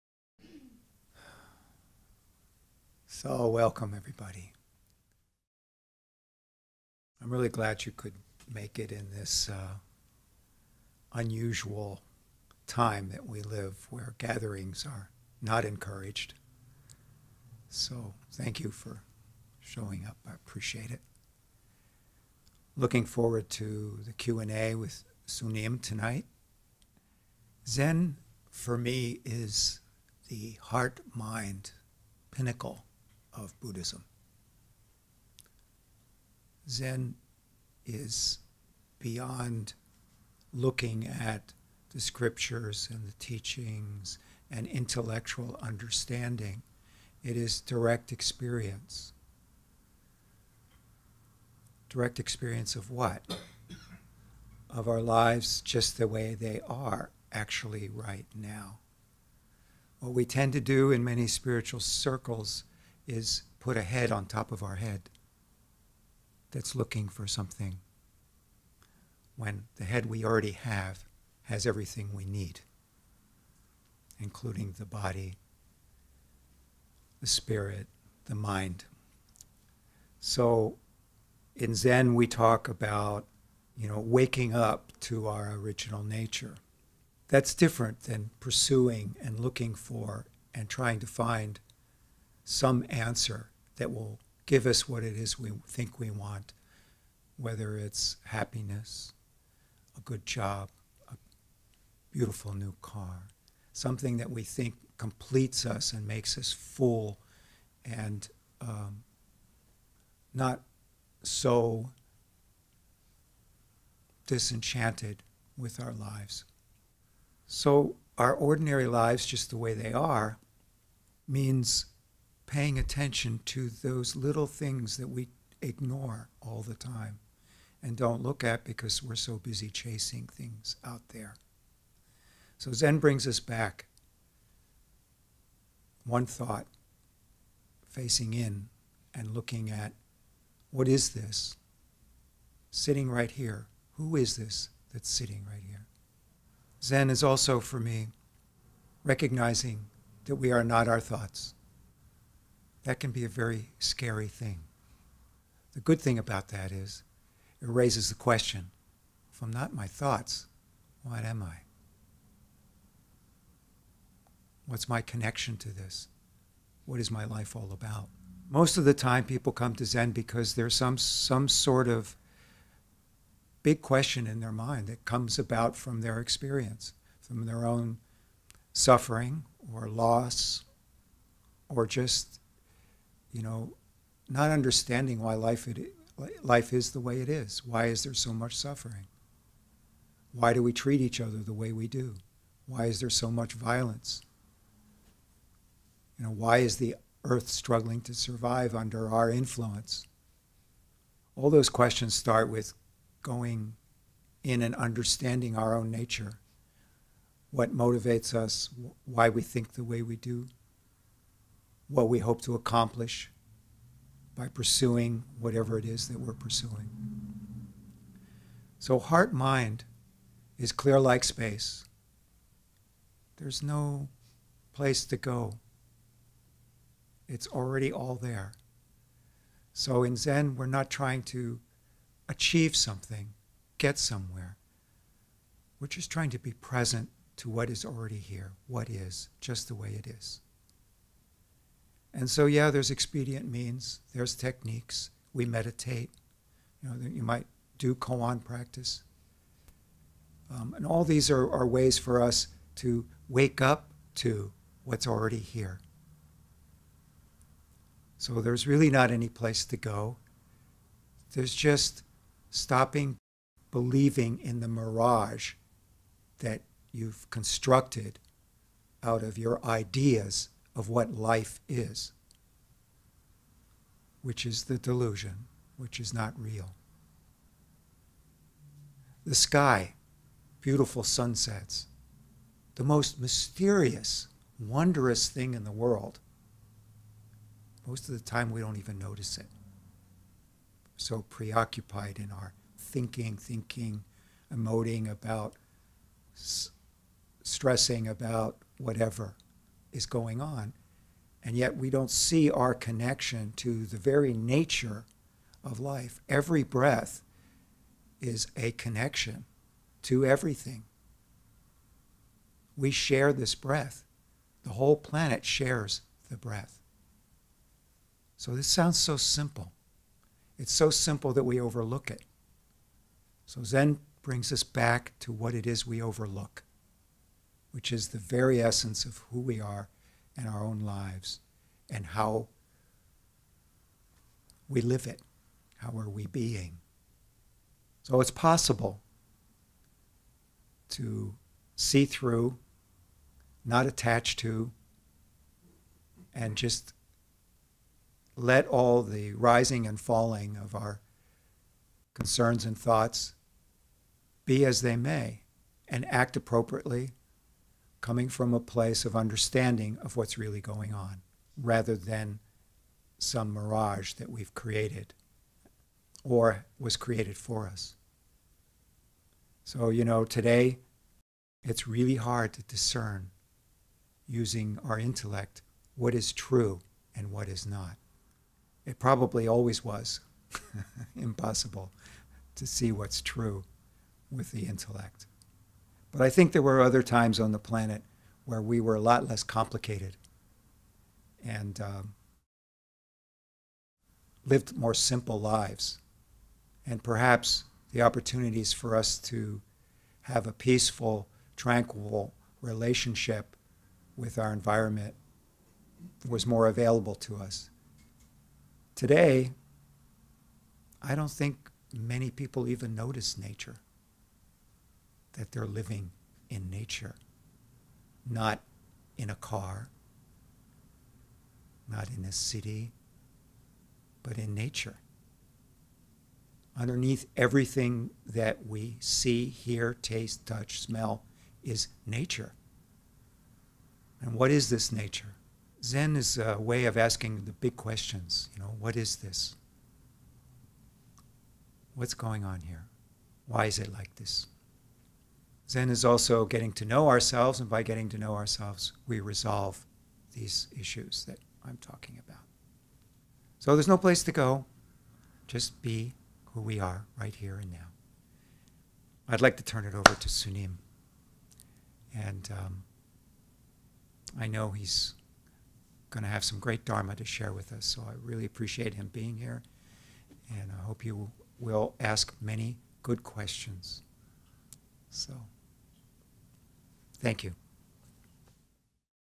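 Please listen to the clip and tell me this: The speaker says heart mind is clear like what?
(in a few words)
space.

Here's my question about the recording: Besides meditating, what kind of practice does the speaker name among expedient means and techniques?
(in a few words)
koan practice.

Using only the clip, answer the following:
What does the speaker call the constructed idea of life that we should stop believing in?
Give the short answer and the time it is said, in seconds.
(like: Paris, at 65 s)
the mirage, at 264 s.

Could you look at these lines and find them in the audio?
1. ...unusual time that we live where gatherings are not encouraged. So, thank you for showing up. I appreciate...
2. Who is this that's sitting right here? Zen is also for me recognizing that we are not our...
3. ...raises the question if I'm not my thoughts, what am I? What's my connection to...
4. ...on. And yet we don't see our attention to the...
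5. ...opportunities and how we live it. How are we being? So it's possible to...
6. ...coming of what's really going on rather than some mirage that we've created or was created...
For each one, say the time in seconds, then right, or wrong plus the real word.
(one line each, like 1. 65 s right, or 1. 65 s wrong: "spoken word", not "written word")
1. 11 s right
2. 143 s right
3. 157 s right
4. 300 s wrong: "connection", not "attention"
5. 330 s wrong: "lives", not "opportunities"
6. 359 s wrong: "understanding", not "coming".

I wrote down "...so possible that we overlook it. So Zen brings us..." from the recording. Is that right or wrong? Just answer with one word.
wrong.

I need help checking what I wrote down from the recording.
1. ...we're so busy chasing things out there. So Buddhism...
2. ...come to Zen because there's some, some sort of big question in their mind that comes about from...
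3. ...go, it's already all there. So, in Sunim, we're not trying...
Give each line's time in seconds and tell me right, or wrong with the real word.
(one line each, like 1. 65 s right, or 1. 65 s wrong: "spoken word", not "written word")
1. 129 s wrong: "Zen", not "Buddhism"
2. 169 s right
3. 225 s wrong: "Zen", not "Sunim".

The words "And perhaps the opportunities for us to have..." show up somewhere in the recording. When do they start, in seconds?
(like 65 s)
396 s.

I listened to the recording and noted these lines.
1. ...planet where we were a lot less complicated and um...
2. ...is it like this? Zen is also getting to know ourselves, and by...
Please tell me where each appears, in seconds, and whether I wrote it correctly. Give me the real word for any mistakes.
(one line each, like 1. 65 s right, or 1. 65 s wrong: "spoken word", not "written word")
1. 387 s right
2. 443 s right.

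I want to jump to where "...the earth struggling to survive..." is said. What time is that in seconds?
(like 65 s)
196 s.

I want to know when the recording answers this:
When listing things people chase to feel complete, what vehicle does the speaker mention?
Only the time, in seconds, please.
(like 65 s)
101 s.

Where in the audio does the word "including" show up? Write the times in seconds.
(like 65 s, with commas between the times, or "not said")
74 s.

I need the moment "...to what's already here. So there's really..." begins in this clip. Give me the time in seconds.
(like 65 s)
254 s.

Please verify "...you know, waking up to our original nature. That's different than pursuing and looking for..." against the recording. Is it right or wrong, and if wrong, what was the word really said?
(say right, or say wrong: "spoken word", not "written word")
right.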